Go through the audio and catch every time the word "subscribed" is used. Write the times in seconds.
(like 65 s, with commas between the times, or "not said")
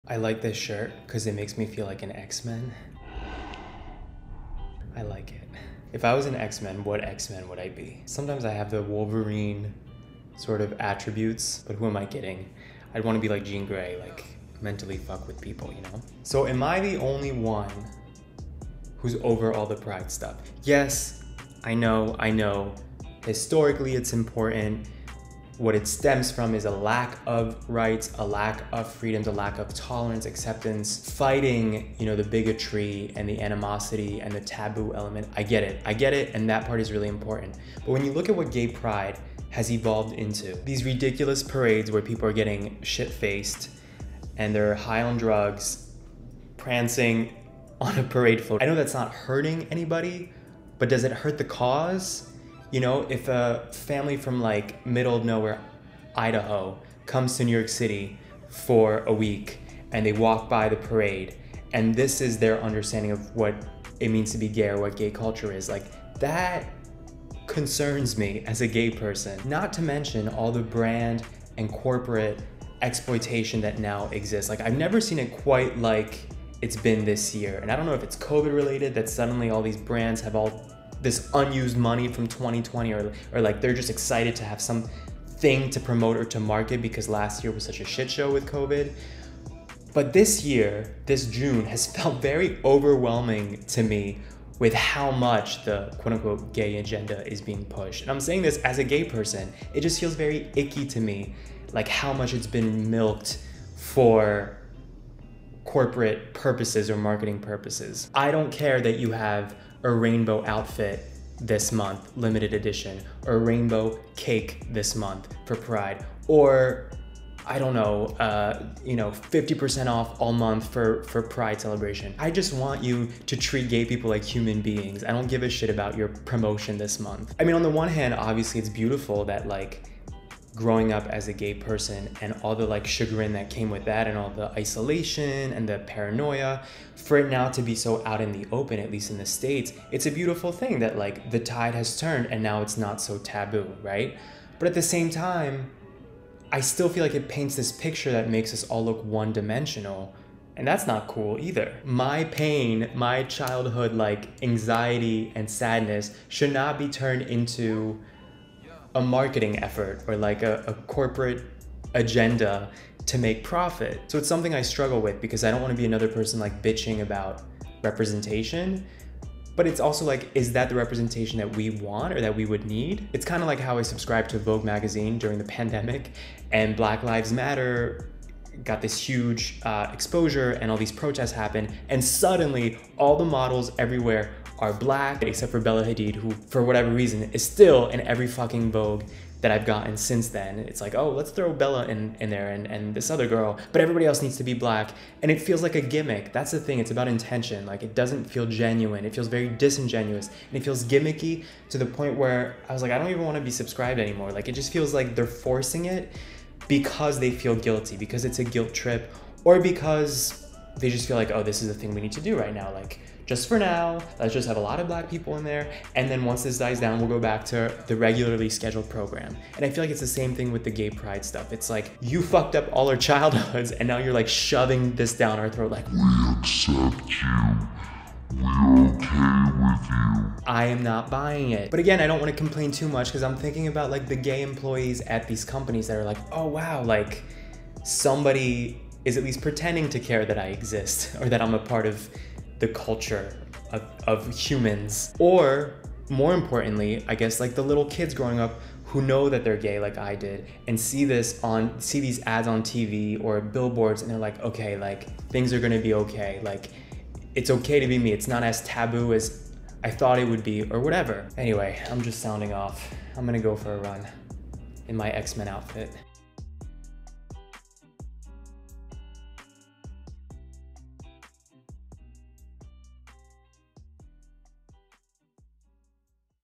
173 s, 203 s.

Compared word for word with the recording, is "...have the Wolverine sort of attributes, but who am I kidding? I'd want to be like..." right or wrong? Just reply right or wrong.
right.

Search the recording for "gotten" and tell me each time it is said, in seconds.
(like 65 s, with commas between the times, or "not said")
189 s.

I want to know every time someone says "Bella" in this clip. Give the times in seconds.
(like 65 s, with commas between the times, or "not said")
185 s, 191 s.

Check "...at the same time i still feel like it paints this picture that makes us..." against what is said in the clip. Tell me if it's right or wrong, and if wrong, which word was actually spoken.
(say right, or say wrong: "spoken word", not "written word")
right.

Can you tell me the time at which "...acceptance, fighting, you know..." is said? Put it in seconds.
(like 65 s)
30 s.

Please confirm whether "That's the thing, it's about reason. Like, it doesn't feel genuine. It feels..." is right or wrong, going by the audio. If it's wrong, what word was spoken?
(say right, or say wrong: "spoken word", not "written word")
wrong: "intention", not "reason".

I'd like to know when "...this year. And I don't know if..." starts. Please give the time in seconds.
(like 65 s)
77 s.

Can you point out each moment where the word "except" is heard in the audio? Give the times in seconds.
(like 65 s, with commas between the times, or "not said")
185 s.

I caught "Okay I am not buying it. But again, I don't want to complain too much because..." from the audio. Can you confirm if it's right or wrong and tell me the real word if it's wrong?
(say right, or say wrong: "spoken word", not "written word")
right.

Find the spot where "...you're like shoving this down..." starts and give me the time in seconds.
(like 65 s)
223 s.